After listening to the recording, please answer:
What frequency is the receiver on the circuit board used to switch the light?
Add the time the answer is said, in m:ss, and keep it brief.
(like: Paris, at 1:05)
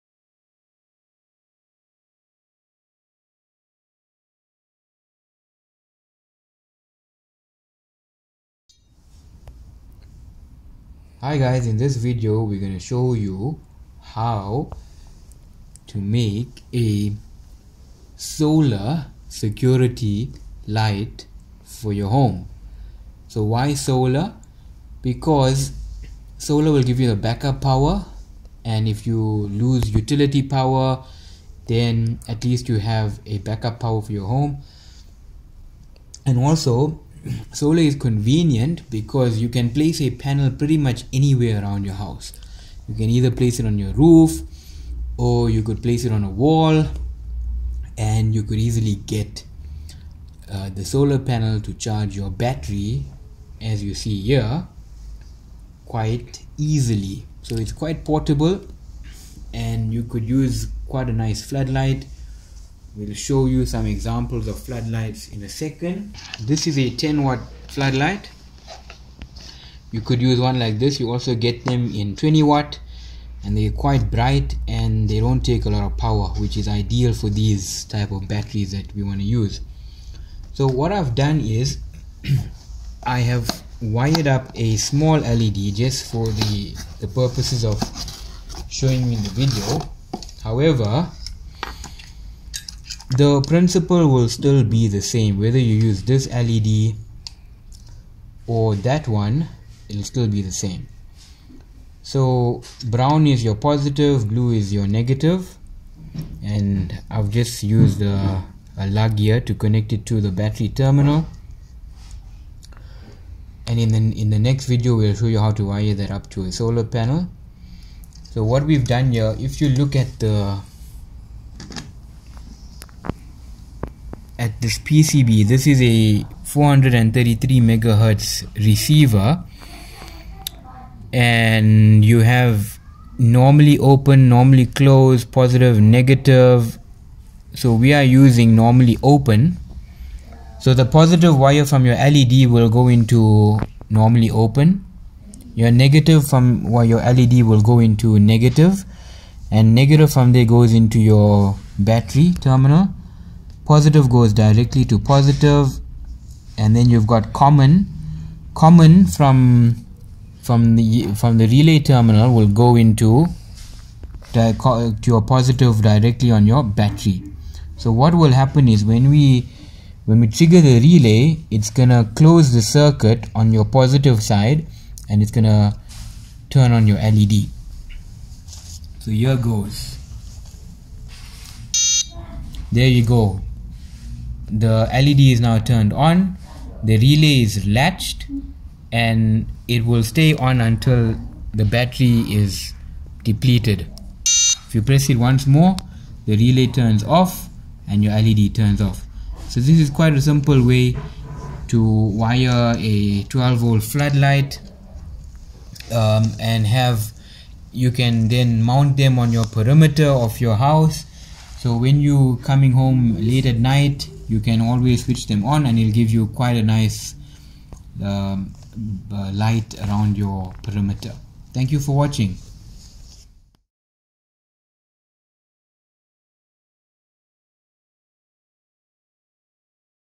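433 megahertz, at 2:06.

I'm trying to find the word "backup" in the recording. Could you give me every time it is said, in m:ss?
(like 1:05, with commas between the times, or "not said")
0:27, 0:33.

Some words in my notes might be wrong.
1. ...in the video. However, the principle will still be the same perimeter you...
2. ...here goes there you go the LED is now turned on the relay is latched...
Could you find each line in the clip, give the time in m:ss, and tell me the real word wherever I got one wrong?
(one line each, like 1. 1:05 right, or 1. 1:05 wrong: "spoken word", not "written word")
1. 1:29 wrong: "whether", not "perimeter"
2. 2:59 right.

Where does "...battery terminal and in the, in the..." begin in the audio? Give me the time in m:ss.
1:50.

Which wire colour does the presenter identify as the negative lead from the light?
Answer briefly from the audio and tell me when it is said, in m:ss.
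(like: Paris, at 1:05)
blue, at 1:44.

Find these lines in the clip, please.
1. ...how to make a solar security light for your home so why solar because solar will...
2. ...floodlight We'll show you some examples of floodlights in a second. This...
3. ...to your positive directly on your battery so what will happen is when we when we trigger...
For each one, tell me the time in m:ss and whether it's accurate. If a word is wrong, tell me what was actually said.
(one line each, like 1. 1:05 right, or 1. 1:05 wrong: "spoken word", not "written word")
1. 0:14 right
2. 1:01 right
3. 2:44 right.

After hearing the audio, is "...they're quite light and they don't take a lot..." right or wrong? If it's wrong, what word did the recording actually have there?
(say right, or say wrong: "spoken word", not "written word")
wrong: "bright", not "light".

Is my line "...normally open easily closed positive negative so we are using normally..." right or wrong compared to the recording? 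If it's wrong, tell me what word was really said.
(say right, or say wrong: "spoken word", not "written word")
wrong: "normally", not "easily".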